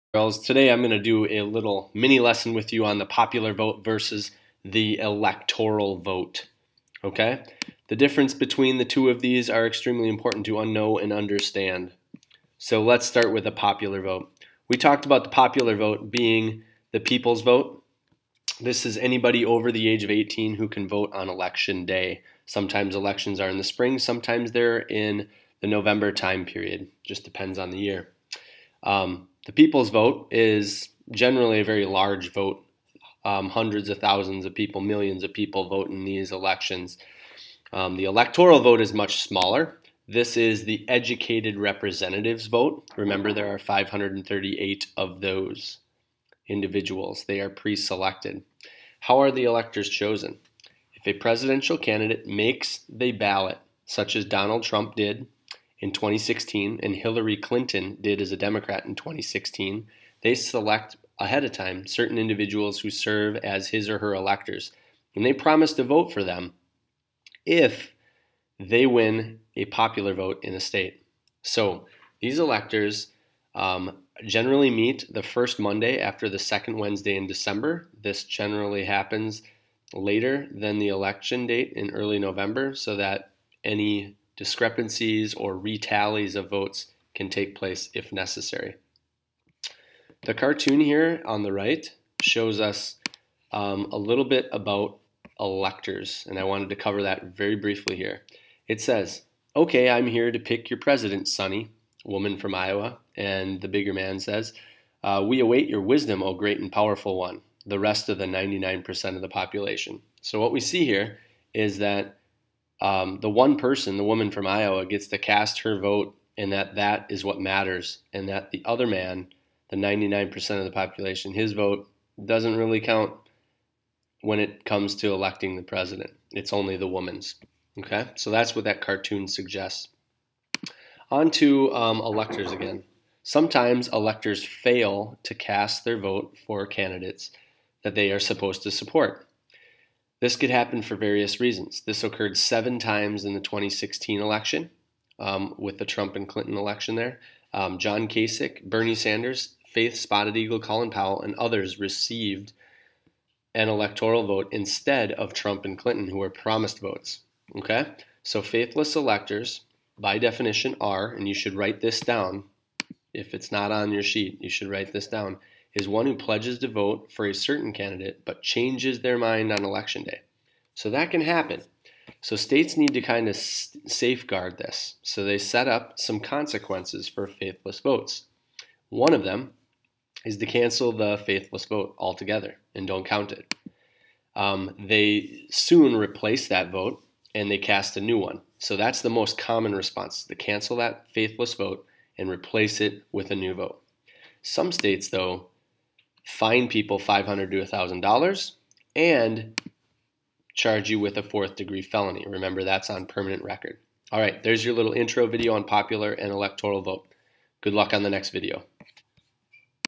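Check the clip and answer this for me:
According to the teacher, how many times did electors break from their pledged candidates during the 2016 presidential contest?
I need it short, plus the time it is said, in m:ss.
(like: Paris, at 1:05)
7, at 2:22.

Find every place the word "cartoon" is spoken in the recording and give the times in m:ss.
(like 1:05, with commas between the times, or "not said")
1:30, 2:08.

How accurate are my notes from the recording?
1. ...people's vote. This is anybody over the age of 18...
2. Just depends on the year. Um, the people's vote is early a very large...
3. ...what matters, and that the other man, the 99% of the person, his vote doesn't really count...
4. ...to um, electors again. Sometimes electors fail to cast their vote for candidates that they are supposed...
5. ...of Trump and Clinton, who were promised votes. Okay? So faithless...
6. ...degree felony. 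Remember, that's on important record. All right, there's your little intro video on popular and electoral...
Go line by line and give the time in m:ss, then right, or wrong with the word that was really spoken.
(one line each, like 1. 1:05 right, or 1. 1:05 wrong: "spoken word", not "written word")
1. 0:16 right
2. 0:27 wrong: "generally", not "early"
3. 1:57 wrong: "population", not "person"
4. 2:11 right
5. 2:35 right
6. 3:21 wrong: "permanent", not "important".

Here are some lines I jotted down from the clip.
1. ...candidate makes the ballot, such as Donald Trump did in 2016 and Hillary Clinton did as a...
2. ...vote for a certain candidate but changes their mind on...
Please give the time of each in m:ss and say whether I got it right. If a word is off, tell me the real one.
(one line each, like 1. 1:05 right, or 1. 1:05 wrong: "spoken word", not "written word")
1. 0:51 right
2. 2:46 right.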